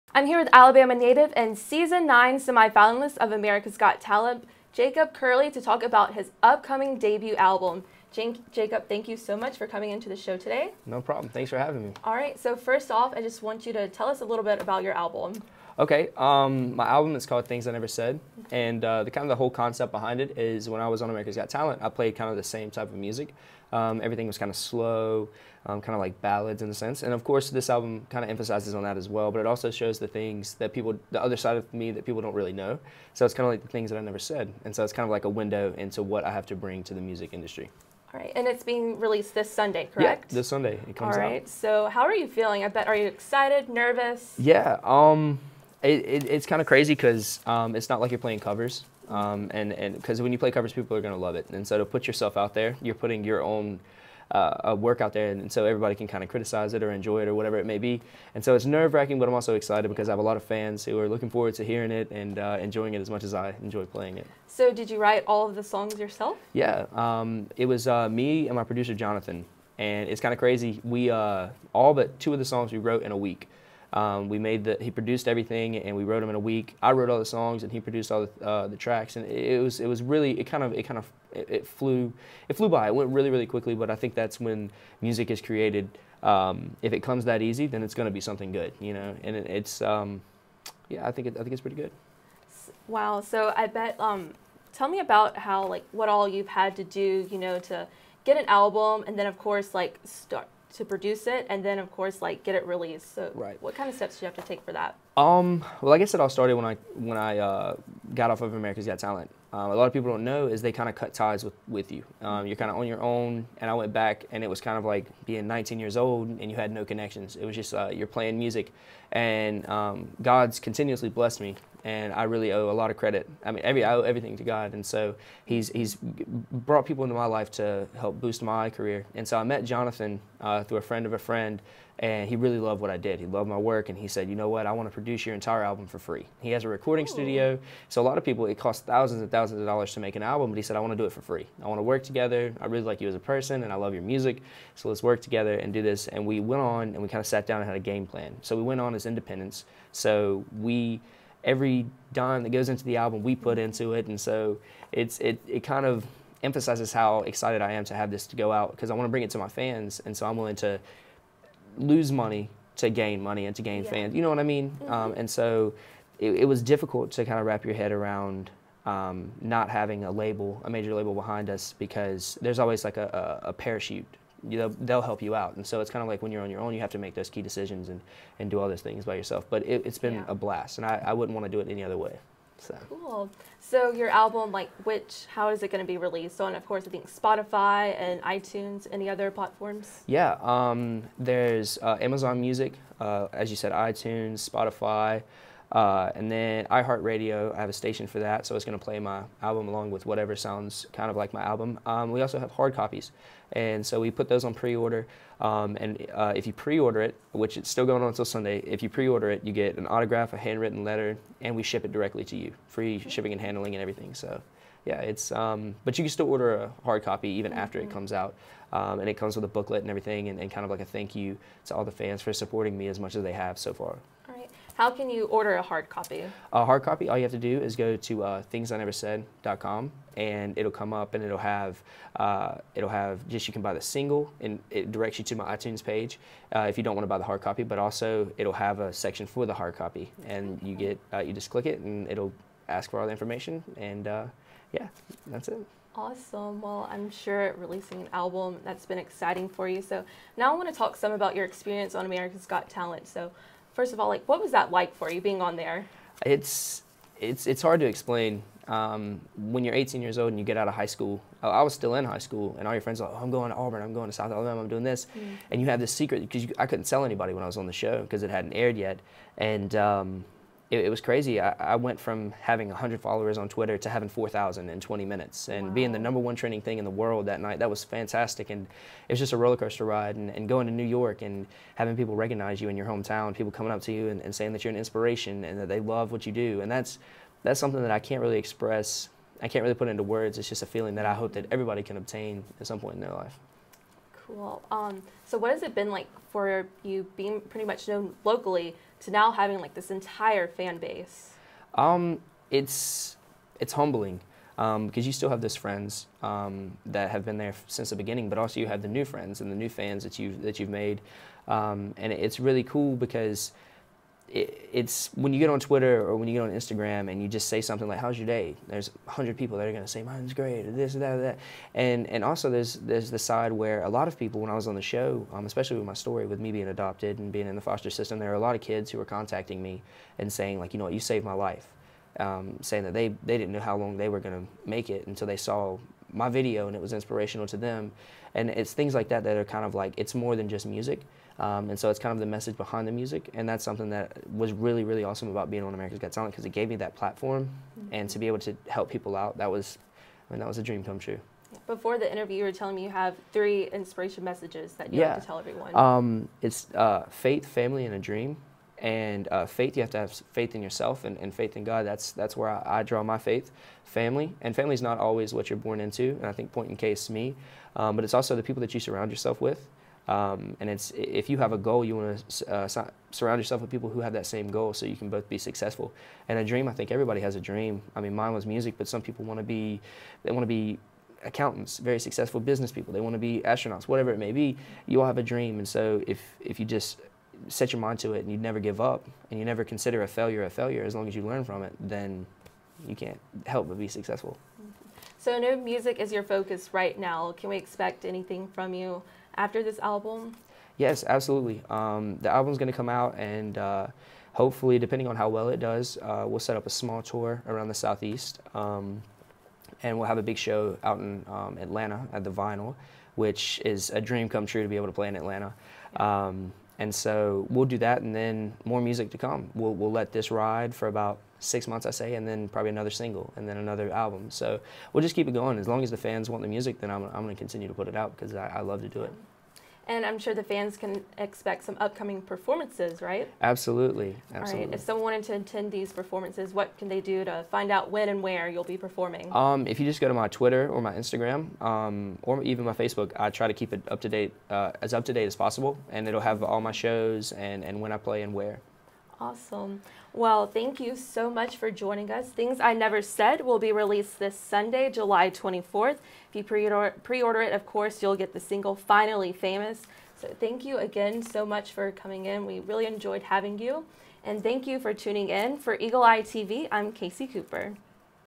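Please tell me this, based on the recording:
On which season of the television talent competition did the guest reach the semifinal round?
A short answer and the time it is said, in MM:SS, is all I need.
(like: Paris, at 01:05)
Season 9, at 00:02.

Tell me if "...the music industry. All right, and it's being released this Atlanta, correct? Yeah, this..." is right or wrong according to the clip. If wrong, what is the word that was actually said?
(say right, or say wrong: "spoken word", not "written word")
wrong: "Sunday", not "Atlanta".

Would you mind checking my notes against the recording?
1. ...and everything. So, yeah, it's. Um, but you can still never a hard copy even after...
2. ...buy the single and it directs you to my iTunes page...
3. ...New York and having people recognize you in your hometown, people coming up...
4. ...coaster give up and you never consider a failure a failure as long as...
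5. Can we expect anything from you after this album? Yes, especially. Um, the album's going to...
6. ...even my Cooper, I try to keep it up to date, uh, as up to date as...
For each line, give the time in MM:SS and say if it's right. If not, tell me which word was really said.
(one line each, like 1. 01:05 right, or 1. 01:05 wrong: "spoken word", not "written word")
1. 03:33 wrong: "order", not "never"
2. 03:53 right
3. 04:40 right
4. 06:28 wrong: "never", not "coaster"
5. 06:37 wrong: "absolutely", not "especially"
6. 07:22 wrong: "Facebook", not "Cooper".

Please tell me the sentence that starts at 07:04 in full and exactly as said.
So we'll just keep it going.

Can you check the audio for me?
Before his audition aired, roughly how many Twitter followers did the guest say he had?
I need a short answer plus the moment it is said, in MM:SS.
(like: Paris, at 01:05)
100, at 04:32.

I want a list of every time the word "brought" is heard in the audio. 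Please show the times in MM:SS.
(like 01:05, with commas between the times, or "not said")
02:05.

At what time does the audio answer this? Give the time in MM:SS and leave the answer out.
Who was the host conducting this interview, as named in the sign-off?
07:46.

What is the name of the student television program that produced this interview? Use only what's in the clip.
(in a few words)
Eagle Eye TV.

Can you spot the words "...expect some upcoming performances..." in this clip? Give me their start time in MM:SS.
07:11.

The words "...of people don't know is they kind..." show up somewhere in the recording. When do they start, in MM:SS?
01:49.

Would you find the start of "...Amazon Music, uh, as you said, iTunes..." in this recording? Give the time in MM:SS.
03:12.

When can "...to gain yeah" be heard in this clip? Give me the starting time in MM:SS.
02:43.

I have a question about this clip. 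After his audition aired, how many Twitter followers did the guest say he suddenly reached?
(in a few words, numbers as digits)
4,000.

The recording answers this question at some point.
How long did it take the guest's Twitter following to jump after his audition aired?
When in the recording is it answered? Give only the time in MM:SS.
04:34.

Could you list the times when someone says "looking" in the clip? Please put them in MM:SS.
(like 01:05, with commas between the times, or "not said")
01:01.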